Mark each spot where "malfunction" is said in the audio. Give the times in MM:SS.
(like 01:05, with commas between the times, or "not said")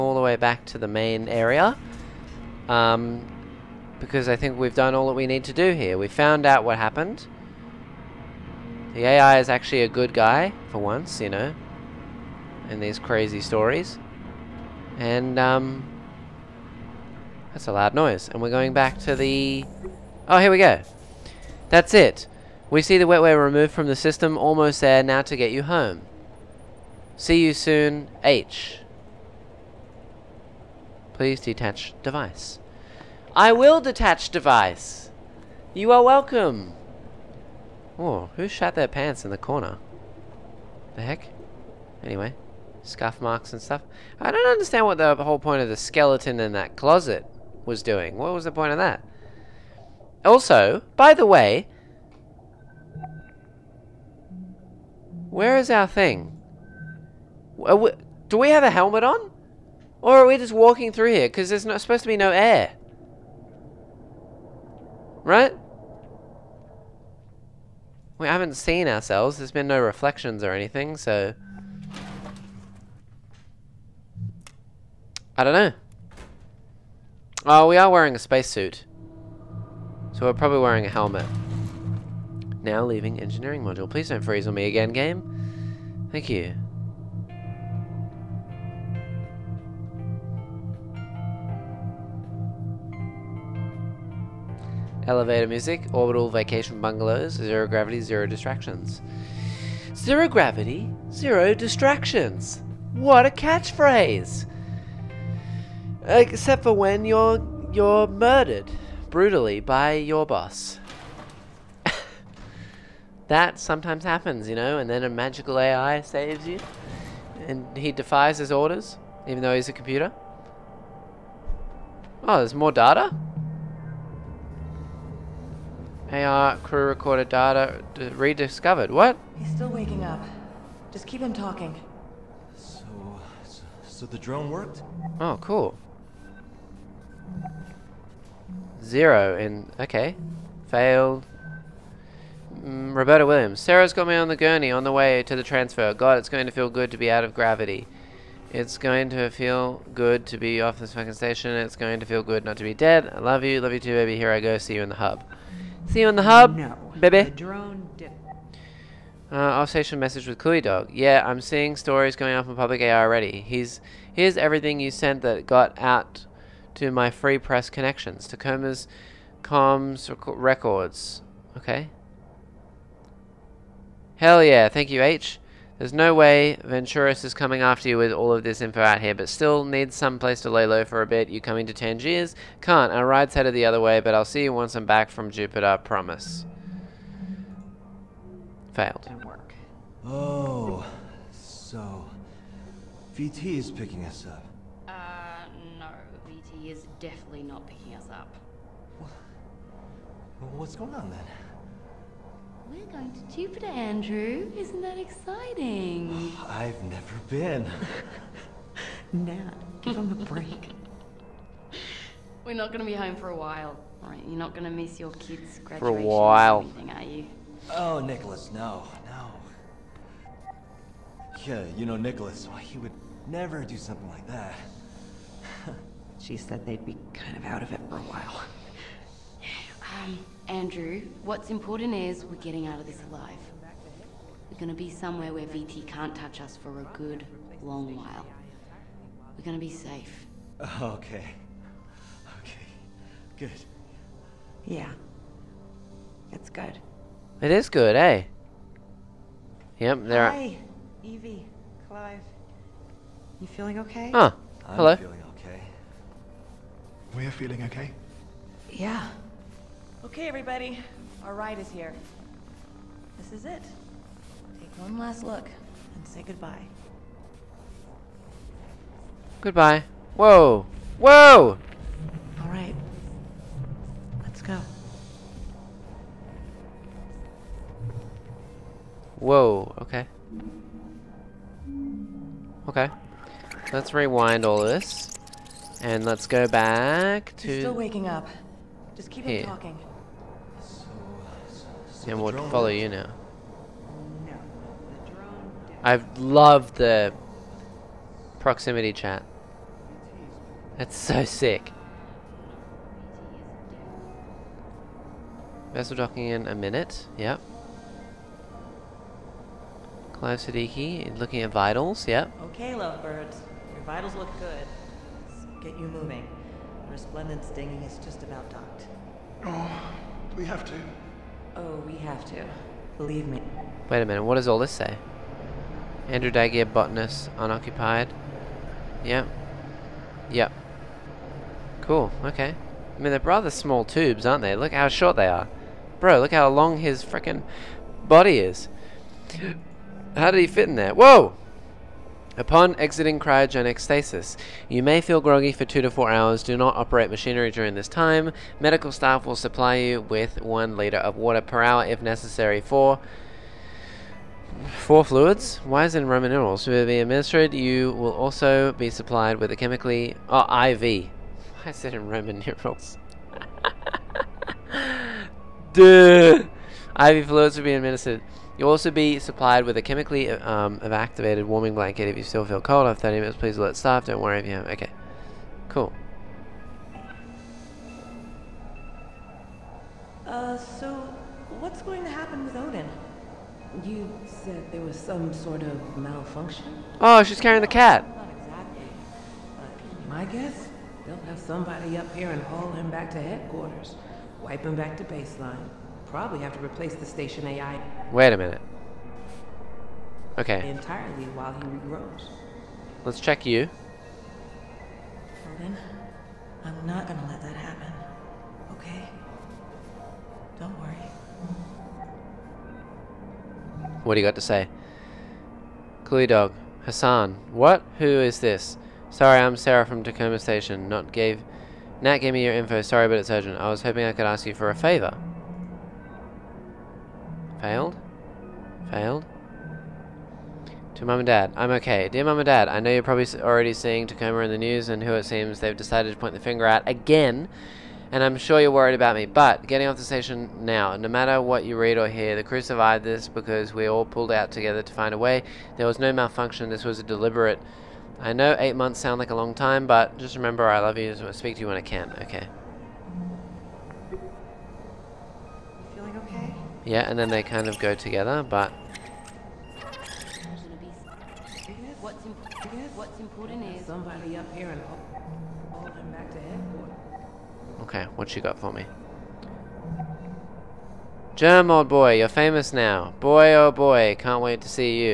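06:25, 07:26.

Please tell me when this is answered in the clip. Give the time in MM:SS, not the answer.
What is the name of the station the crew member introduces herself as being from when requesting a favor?
07:00.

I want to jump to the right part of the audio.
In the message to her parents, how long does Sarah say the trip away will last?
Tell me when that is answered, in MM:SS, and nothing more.
07:28.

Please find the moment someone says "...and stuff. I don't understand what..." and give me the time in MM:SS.
00:43.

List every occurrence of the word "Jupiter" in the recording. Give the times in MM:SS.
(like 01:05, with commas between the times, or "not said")
03:05, 03:23.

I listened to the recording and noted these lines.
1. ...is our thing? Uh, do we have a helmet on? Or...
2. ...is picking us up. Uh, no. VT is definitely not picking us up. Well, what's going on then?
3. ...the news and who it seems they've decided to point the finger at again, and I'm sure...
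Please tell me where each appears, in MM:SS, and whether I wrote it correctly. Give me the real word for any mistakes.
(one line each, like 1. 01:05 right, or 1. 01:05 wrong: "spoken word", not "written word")
1. 00:55 right
2. 03:13 right
3. 07:14 right.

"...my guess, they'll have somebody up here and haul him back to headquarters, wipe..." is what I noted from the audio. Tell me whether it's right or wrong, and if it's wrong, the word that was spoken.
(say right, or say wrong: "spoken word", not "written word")
right.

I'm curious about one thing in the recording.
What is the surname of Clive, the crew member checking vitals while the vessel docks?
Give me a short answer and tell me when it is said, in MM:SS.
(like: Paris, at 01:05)
Siddiqui, at 05:10.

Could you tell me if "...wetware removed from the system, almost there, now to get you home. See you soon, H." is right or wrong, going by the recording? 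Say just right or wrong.
right.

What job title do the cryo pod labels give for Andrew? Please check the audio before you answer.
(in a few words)
Botanist.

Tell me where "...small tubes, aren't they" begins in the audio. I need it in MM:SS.
05:33.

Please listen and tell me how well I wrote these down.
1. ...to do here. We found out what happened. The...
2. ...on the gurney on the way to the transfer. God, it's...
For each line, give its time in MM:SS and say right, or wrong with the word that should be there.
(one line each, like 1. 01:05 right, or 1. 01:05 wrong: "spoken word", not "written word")
1. 00:05 right
2. 02:24 right.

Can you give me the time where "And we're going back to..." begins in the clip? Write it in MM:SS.
00:18.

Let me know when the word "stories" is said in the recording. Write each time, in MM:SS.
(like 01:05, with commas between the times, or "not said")
00:13, 02:41.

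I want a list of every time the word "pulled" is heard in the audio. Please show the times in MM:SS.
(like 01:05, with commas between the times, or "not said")
07:24.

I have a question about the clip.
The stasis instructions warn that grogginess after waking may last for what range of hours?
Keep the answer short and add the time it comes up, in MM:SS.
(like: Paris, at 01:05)
2 to 4 hours, at 05:45.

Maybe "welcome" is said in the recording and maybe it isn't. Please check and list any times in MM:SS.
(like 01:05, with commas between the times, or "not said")
00:36.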